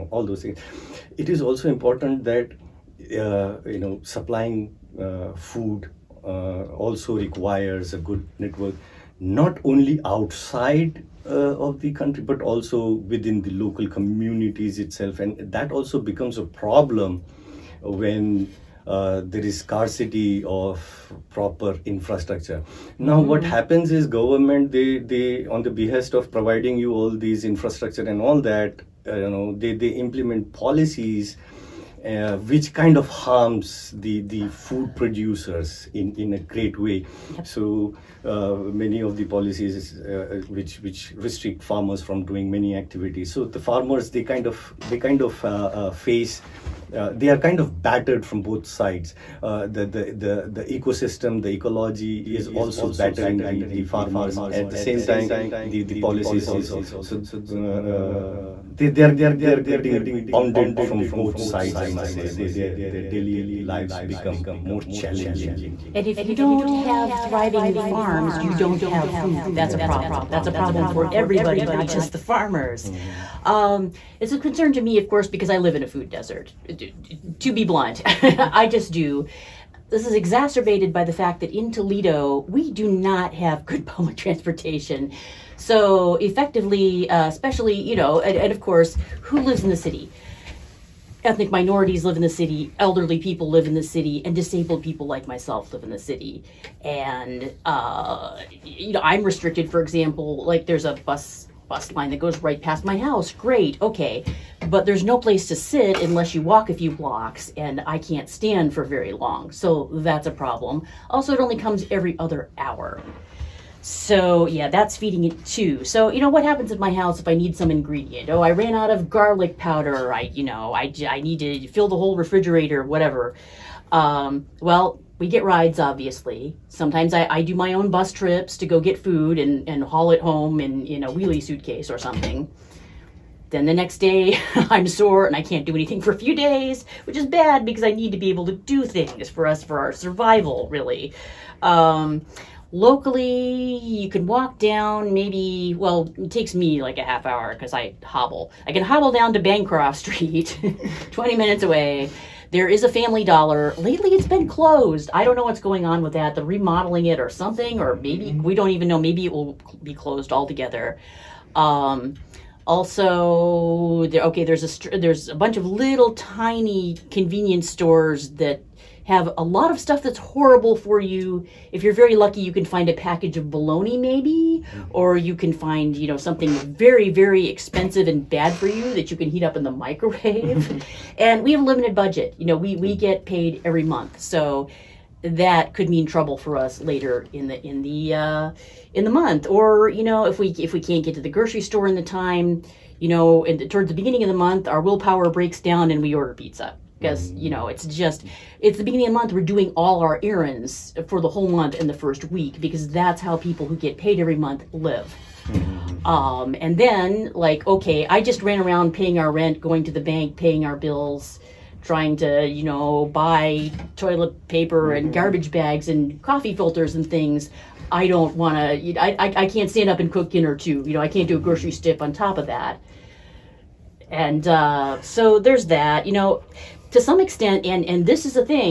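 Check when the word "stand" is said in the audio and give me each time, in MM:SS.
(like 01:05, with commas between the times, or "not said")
01:48, 03:39.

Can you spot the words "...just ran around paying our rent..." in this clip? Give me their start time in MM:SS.
03:28.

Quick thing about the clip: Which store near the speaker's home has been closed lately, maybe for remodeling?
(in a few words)
Family Dollar.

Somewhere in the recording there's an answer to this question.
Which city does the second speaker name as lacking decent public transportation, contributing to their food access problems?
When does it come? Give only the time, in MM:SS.
01:21.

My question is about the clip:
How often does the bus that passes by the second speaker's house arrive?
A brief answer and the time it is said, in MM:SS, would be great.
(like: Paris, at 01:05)
every other hour, at 01:51.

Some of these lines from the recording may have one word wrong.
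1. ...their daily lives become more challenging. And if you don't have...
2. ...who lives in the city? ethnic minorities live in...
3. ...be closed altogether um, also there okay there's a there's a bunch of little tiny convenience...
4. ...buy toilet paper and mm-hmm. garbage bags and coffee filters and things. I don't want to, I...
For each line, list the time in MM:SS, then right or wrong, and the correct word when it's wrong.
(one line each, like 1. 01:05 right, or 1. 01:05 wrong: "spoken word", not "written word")
1. 01:02 right
2. 01:29 right
3. 02:39 right
4. 03:33 right.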